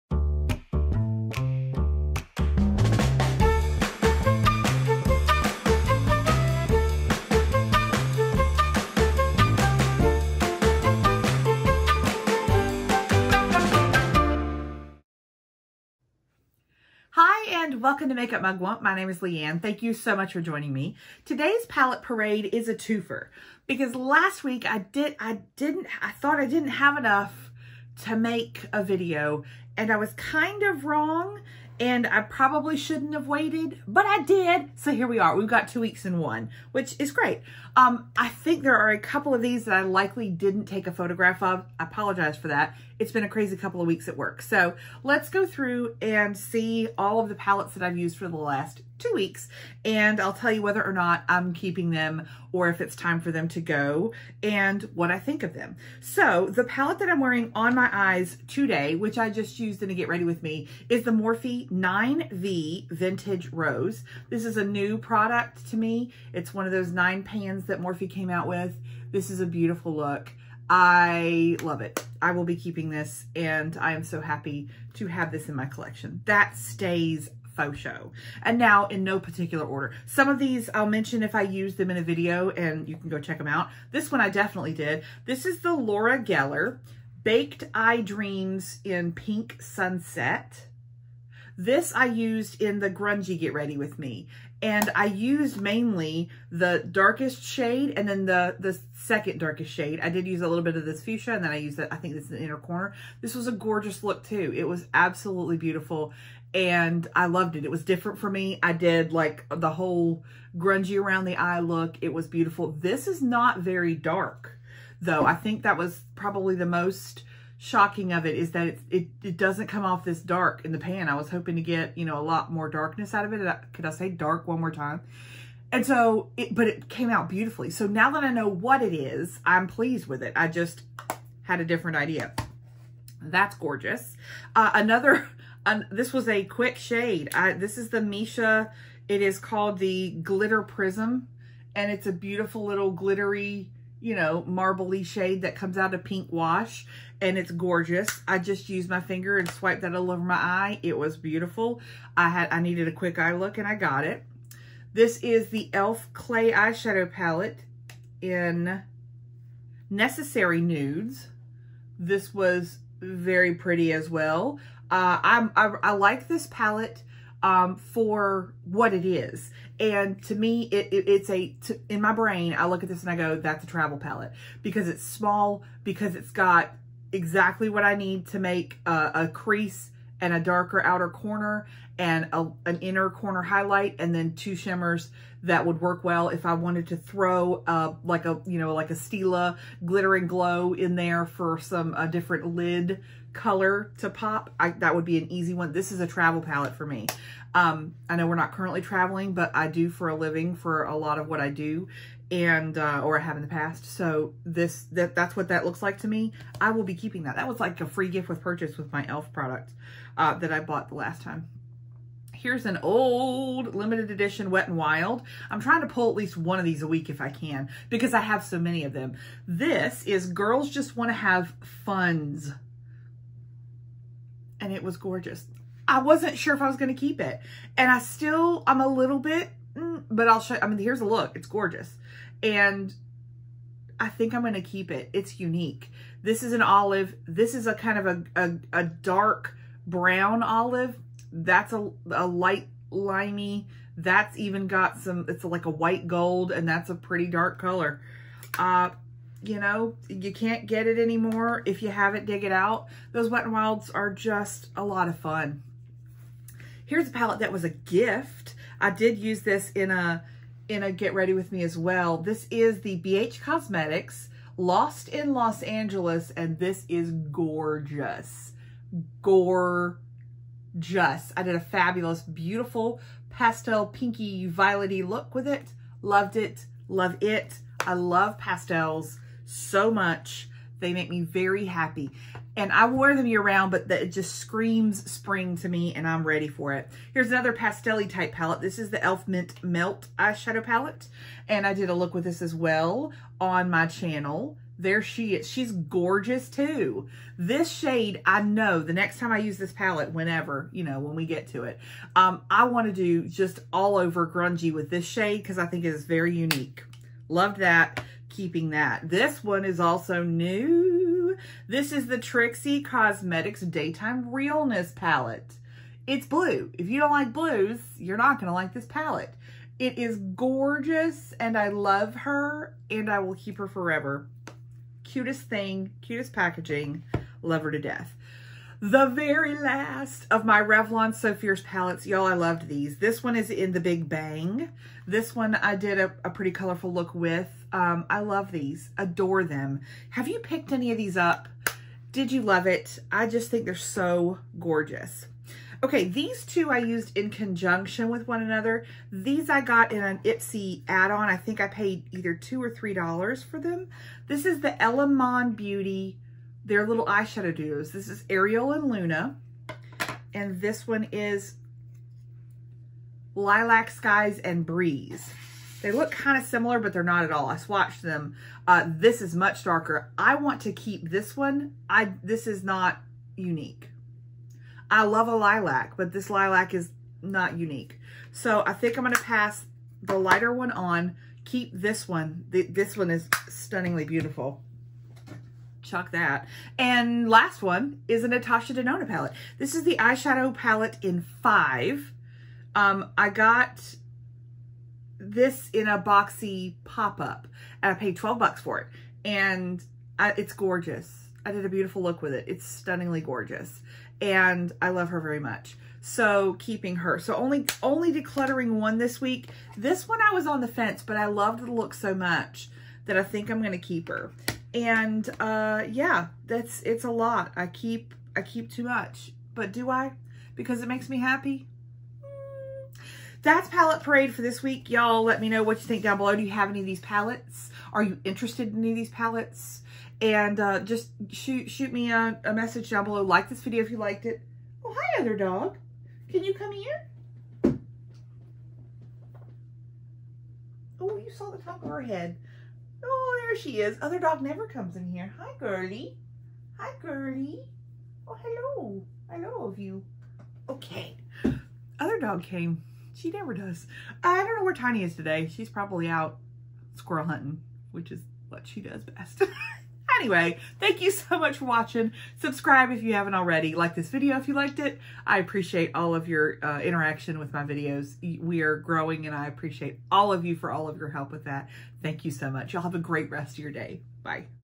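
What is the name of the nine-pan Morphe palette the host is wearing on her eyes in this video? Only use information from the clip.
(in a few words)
Vintage Rose.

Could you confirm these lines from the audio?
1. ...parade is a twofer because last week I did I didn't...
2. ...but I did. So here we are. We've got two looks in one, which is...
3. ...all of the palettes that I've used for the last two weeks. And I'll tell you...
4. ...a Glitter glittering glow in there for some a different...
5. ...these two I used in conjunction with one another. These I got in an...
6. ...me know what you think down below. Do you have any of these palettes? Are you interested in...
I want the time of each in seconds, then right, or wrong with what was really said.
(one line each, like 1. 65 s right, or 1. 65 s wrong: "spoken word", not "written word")
1. 22 s right
2. 33 s wrong: "weeks", not "looks"
3. 46 s right
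4. 188 s wrong: "Stila", not "Glitter"
5. 346 s right
6. 425 s right.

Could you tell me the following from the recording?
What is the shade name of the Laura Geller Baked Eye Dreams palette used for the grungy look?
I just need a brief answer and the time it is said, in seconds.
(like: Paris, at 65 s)
Pink Sunset, at 89 s.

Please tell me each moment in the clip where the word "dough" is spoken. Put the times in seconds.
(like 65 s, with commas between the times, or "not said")
not said.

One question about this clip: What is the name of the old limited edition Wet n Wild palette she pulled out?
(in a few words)
Girls Just Want to Have Funds.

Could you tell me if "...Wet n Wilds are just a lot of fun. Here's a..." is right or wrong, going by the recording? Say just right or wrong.
right.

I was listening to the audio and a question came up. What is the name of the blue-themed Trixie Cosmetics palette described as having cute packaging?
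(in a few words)
Daytime Realness.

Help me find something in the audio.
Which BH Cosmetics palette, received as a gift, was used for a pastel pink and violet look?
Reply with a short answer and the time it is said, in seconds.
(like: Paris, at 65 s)
Lost in Los Angeles, at 264 s.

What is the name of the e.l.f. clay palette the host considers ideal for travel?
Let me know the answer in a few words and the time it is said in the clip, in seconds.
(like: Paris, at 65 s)
Necessary Nudes, at 159 s.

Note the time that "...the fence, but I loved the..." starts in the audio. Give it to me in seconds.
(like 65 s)
410 s.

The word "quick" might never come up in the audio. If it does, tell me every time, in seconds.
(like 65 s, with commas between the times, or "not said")
136 s, 152 s.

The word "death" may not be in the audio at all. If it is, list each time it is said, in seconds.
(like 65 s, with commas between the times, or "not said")
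327 s.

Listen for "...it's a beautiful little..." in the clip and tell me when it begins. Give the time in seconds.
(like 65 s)
141 s.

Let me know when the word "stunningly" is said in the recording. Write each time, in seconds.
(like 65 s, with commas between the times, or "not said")
383 s, 402 s.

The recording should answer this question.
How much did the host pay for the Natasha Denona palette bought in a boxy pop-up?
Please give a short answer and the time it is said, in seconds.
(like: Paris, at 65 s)
$12, at 398 s.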